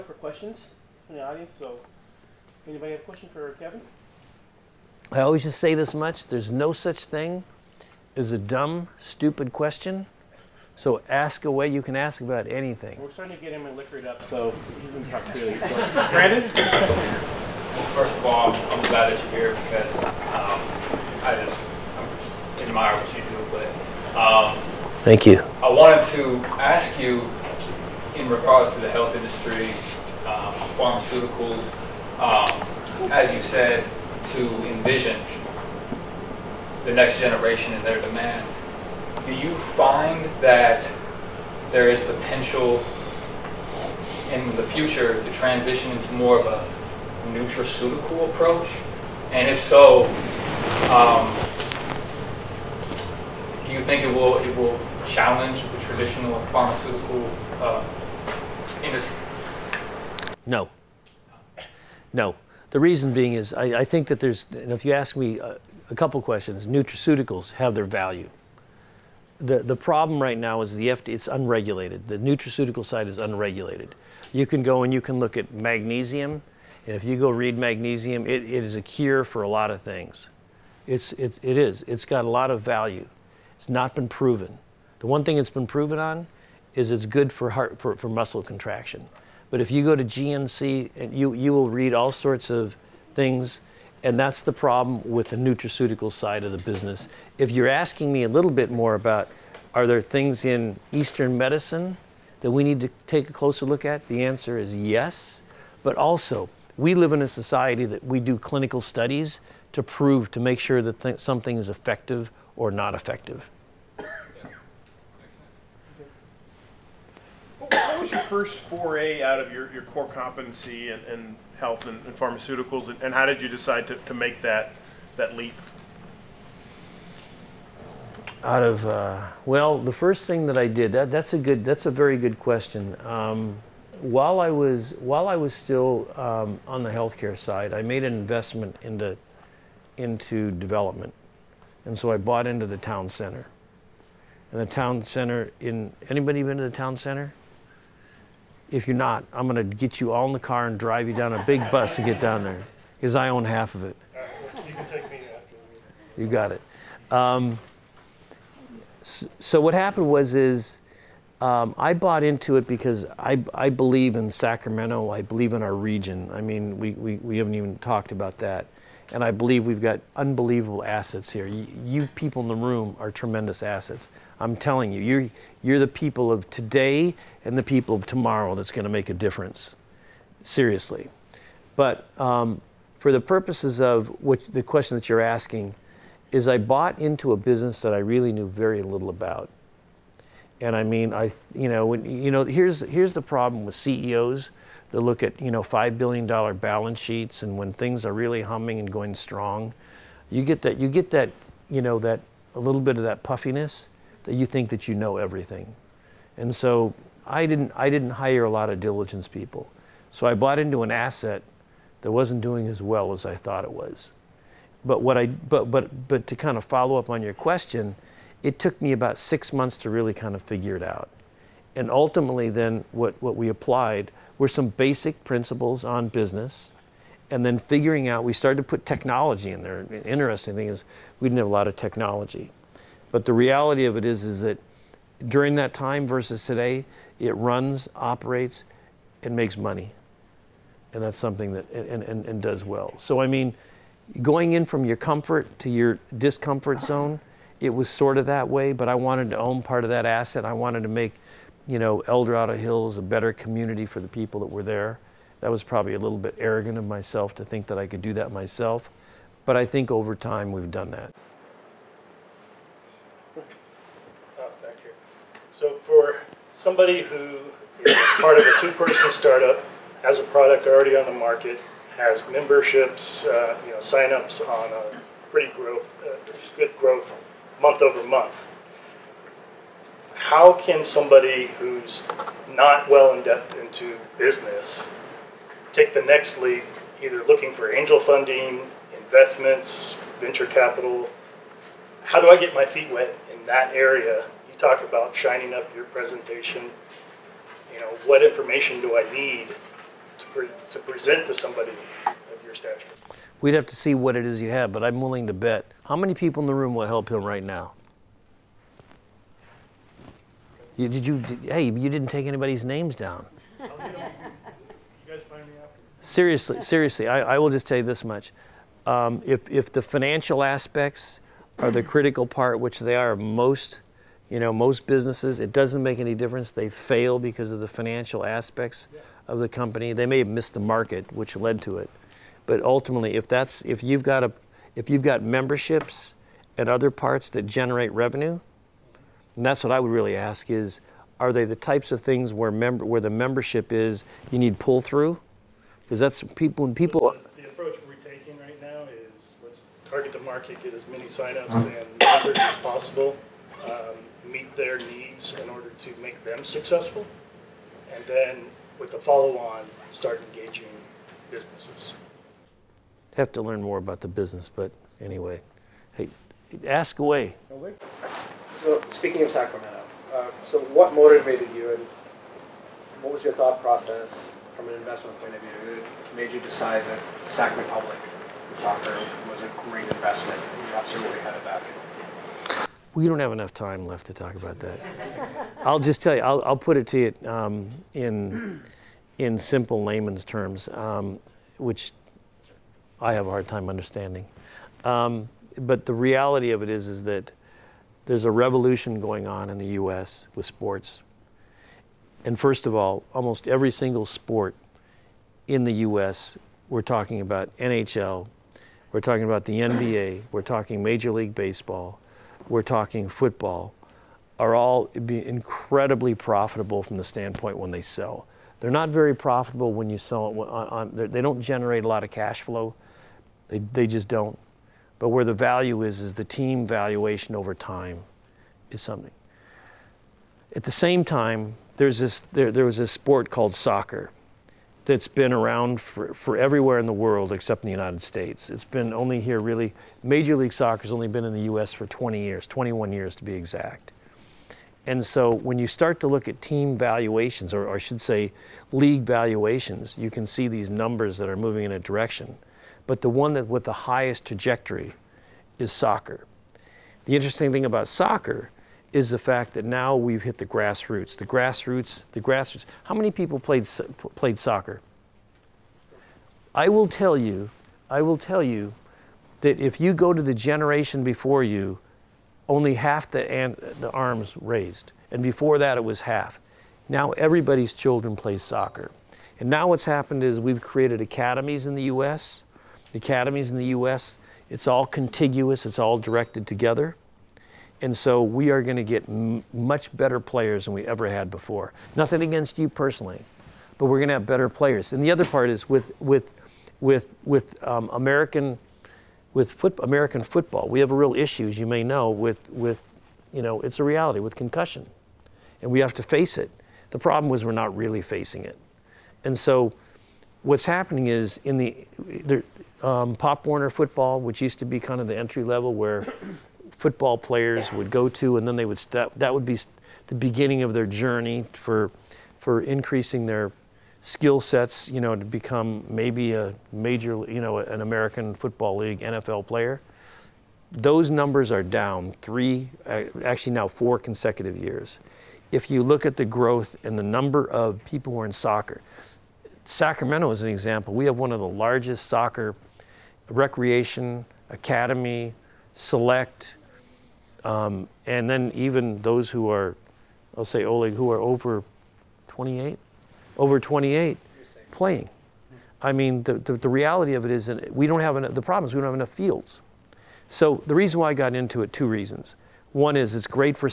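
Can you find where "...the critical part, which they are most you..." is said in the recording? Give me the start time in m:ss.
5:21.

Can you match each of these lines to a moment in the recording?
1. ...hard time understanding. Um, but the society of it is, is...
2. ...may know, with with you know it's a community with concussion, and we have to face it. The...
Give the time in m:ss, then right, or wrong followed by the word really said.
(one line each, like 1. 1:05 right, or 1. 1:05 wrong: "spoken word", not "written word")
1. 6:33 wrong: "reality", not "society"
2. 8:21 wrong: "reality", not "community".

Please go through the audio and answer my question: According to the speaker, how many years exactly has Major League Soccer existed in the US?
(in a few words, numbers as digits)
21.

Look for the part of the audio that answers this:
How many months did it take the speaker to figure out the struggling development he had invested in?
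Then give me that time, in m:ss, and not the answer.
3:39.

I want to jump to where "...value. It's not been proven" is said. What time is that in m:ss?
1:22.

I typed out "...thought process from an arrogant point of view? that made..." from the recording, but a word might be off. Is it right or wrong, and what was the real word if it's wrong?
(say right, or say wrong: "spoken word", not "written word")
wrong: "investment", not "arrogant".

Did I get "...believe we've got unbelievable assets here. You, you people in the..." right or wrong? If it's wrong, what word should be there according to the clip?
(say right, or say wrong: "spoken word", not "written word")
right.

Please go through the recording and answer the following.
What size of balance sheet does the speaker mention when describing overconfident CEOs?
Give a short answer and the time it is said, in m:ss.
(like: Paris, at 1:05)
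$5 billion, at 3:15.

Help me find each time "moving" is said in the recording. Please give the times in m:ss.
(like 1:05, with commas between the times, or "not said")
7:31.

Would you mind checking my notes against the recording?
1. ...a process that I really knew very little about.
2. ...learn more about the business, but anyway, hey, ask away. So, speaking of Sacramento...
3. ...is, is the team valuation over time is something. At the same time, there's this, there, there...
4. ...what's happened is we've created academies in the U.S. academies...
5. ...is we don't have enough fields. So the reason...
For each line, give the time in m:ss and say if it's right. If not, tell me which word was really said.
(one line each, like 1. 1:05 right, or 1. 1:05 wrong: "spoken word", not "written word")
1. 3:07 wrong: "business", not "process"
2. 6:03 right
3. 7:05 right
4. 7:59 right
5. 9:18 right.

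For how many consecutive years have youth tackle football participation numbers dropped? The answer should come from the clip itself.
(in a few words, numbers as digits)
4.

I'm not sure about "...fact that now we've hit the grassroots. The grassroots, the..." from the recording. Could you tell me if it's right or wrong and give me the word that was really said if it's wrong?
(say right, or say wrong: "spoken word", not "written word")
right.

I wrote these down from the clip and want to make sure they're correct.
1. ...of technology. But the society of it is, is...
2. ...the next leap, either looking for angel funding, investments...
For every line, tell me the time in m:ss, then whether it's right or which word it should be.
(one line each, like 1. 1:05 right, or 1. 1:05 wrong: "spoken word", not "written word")
1. 3:51 wrong: "reality", not "society"
2. 4:45 right.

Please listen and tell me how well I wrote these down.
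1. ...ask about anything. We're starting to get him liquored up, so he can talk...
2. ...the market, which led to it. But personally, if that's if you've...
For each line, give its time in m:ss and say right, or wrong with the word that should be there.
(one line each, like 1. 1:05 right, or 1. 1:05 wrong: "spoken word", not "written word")
1. 0:11 right
2. 5:30 wrong: "ultimately", not "personally".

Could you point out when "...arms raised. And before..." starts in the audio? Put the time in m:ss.
7:53.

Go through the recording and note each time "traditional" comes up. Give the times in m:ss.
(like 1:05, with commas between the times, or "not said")
0:55.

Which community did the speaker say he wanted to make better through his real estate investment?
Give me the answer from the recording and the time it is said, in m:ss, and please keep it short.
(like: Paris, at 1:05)
El Dorado Hills, at 4:12.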